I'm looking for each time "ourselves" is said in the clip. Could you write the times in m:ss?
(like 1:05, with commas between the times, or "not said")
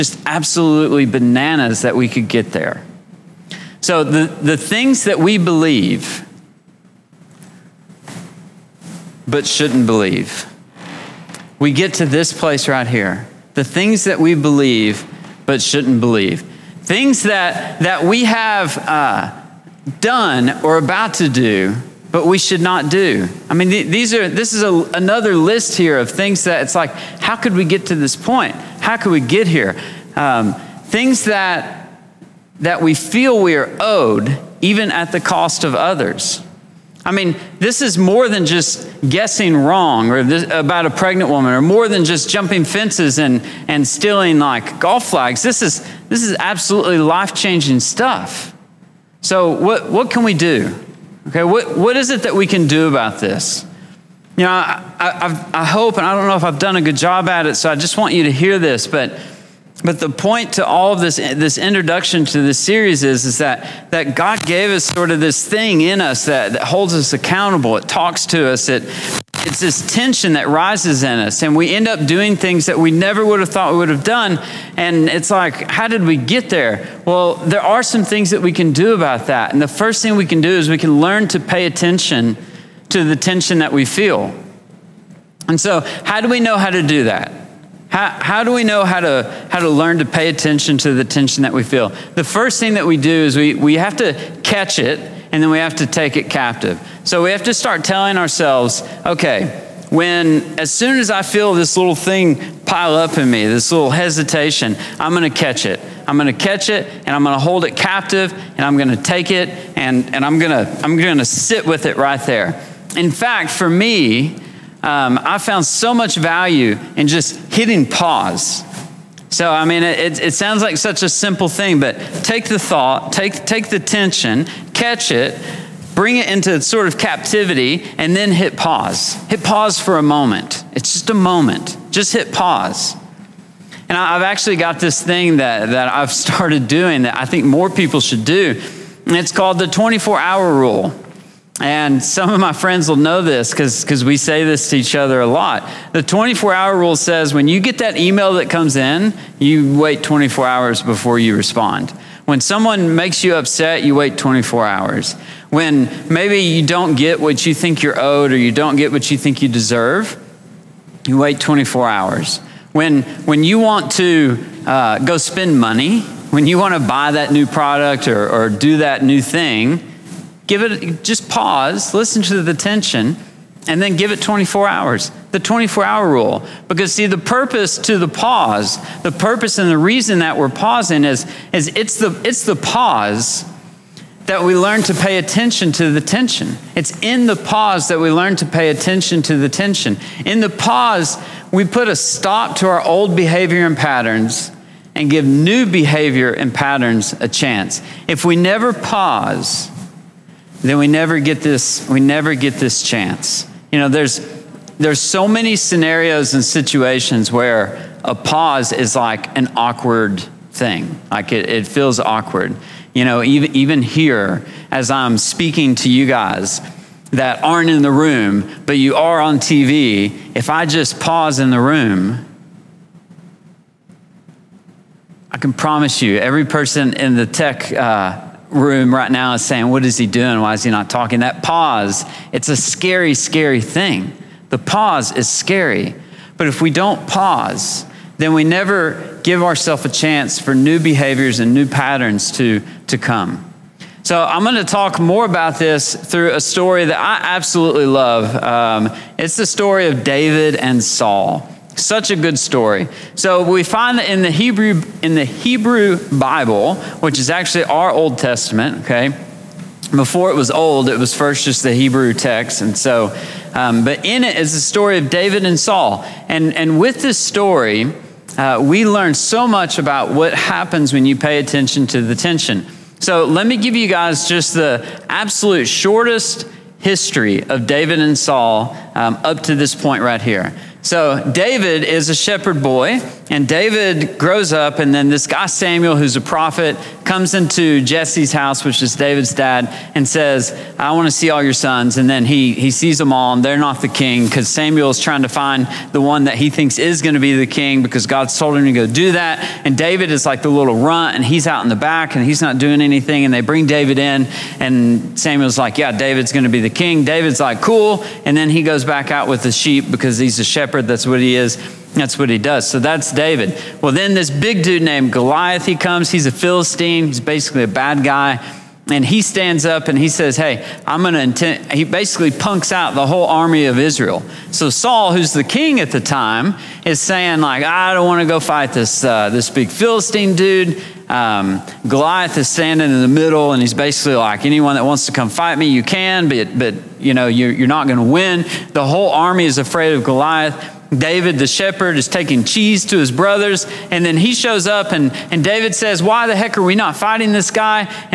1:38, 3:59.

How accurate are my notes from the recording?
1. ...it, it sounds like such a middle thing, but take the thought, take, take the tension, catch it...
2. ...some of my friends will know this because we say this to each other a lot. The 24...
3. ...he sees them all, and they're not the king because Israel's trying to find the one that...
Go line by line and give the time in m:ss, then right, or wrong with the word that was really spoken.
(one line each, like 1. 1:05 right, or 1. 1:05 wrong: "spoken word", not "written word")
1. 1:59 wrong: "simple", not "middle"
2. 2:22 right
3. 4:52 wrong: "Samuel", not "Israel".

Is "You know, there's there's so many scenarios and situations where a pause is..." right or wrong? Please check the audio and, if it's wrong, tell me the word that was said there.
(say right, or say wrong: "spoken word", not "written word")
right.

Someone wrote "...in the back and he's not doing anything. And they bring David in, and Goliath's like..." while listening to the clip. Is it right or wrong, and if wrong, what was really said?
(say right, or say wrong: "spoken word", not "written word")
wrong: "Samuel", not "Goliath".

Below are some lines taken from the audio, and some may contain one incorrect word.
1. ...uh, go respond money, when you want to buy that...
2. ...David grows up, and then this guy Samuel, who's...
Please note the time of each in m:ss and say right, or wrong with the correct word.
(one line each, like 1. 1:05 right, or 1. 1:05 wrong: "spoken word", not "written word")
1. 2:44 wrong: "spend", not "respond"
2. 4:43 right.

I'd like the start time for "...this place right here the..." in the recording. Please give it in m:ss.
0:12.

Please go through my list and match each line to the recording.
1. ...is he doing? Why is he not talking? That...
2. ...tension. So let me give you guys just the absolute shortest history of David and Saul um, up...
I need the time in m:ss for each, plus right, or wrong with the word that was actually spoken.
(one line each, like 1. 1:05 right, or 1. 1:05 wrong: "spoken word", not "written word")
1. 3:49 right
2. 4:32 right.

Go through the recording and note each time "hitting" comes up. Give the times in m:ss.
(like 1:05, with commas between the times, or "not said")
1:57.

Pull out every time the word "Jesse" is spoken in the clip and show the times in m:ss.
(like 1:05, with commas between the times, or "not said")
4:47.